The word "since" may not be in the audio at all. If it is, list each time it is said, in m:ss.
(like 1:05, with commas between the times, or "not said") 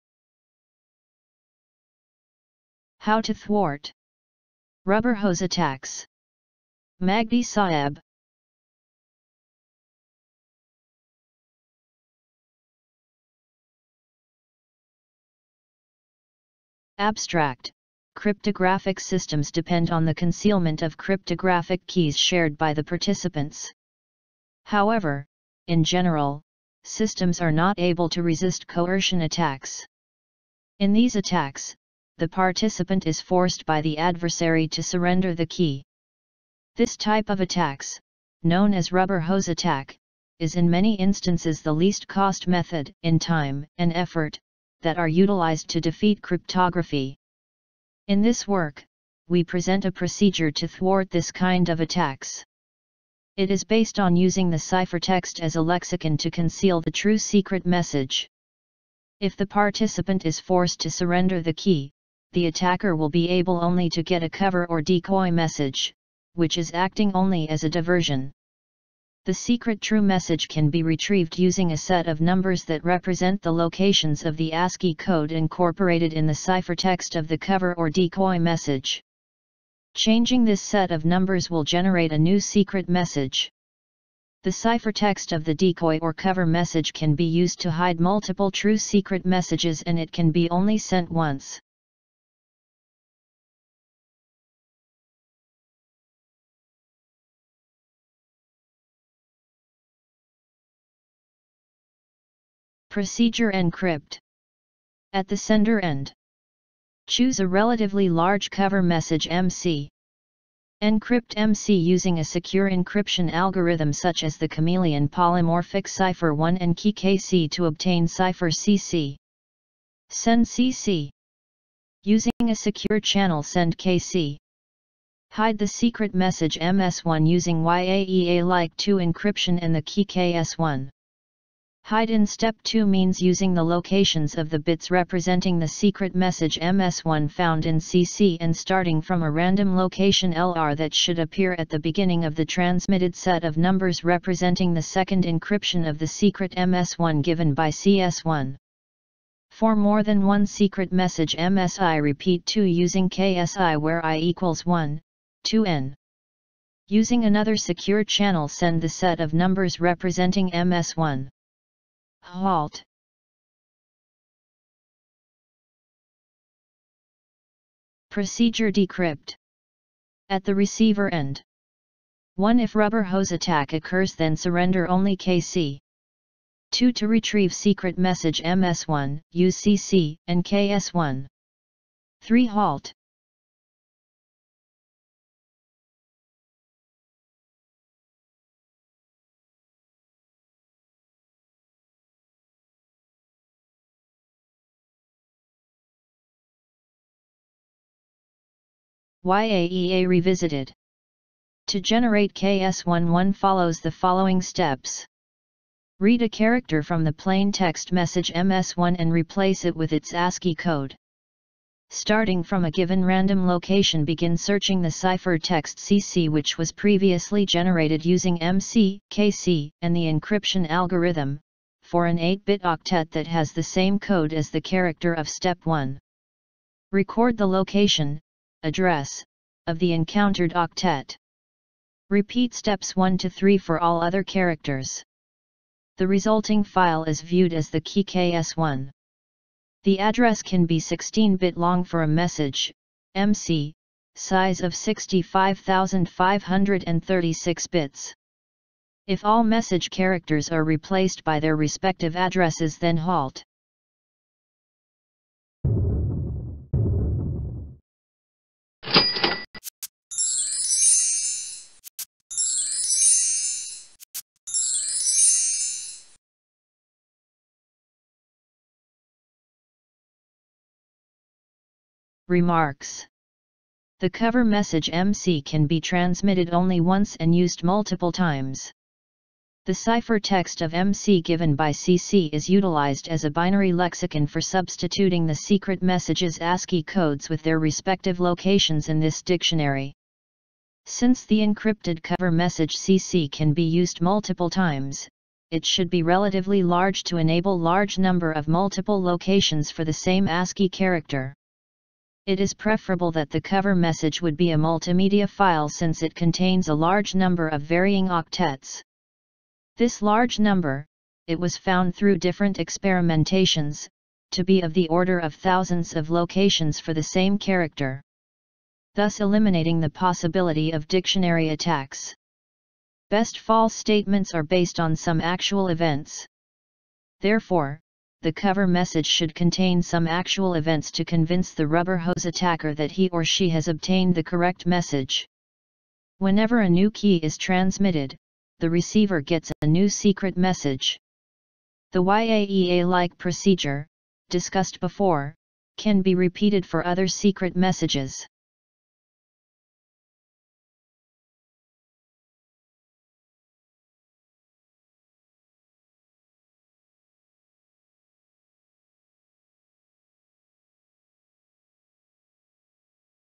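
4:50, 5:05.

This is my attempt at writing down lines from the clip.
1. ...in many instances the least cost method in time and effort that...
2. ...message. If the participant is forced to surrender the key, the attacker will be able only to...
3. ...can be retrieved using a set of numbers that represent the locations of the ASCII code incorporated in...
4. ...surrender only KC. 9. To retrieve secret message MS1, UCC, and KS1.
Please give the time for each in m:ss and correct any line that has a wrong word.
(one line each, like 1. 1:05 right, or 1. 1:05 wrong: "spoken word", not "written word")
1. 0:40 right
2. 0:57 right
3. 1:10 right
4. 2:54 wrong: "2", not "9".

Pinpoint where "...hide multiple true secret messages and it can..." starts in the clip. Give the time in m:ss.
1:27.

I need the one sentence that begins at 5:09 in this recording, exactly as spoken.
This large number, it was found through different experimentations, to be of the order of thousands of locations for the same character.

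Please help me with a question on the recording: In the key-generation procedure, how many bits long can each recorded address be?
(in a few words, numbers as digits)
16.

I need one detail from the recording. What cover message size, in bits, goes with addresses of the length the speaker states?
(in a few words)
65536.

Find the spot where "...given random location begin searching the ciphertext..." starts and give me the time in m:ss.
3:32.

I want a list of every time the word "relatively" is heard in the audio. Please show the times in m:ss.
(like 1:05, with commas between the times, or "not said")
1:47, 4:56.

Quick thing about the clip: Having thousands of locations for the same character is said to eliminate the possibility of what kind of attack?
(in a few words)
dictionary attacks.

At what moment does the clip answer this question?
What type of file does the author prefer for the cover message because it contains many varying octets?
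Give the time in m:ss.
5:04.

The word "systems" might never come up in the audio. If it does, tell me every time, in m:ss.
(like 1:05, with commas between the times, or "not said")
0:18, 0:26.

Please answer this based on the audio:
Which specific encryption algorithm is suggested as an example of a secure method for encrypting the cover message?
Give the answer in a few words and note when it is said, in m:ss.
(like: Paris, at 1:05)
Chameleon Polymorphic Cipher, at 1:54.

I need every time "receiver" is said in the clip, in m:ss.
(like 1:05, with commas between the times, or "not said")
2:50, 5:38.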